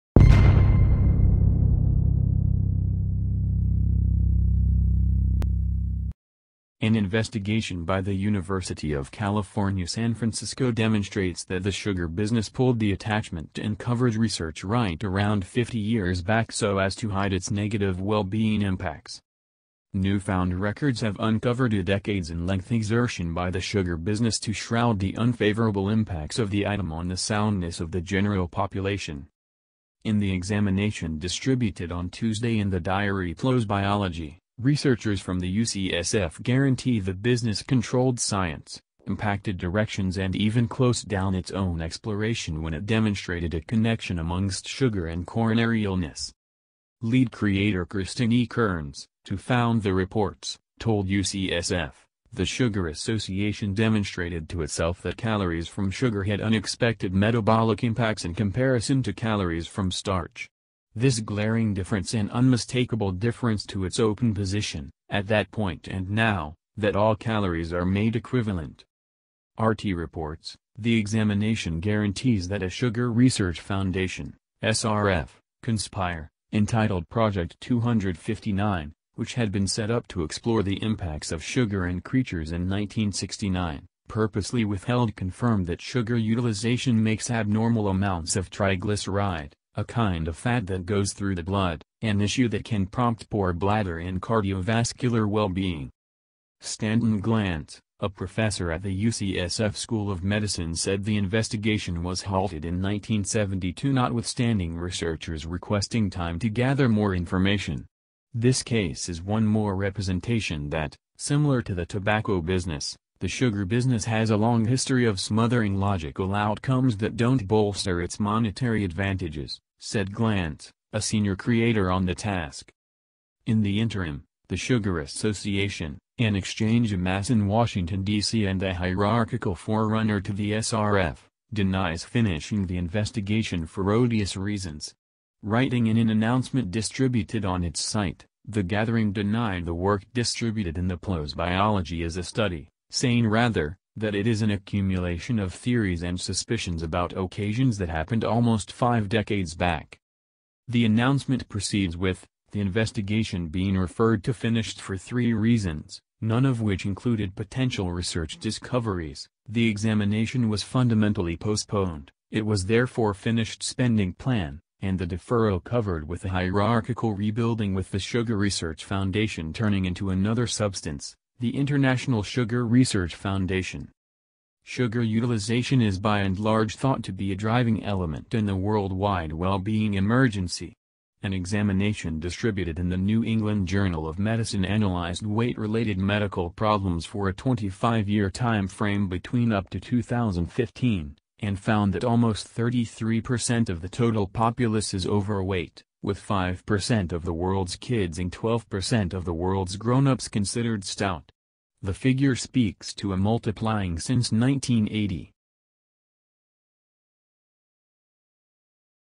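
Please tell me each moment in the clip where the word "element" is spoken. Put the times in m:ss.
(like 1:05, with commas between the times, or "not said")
2:57.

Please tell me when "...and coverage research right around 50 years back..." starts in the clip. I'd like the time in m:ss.
0:13.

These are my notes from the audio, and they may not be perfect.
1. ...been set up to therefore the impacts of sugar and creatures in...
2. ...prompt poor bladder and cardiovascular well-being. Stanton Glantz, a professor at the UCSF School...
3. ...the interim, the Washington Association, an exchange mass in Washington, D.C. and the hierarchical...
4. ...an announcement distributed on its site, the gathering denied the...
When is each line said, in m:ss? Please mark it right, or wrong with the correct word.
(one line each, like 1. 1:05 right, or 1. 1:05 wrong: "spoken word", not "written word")
1. 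1:19 wrong: "explore", not "therefore"
2. 1:32 right
3. 2:03 wrong: "Sugar", not "Washington"
4. 2:15 right.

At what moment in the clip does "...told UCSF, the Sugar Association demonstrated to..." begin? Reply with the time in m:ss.
0:50.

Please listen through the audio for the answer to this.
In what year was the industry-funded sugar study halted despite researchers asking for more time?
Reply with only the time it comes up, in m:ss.
1:42.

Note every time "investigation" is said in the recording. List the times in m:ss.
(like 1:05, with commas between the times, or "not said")
0:06, 1:41, 2:12, 2:32.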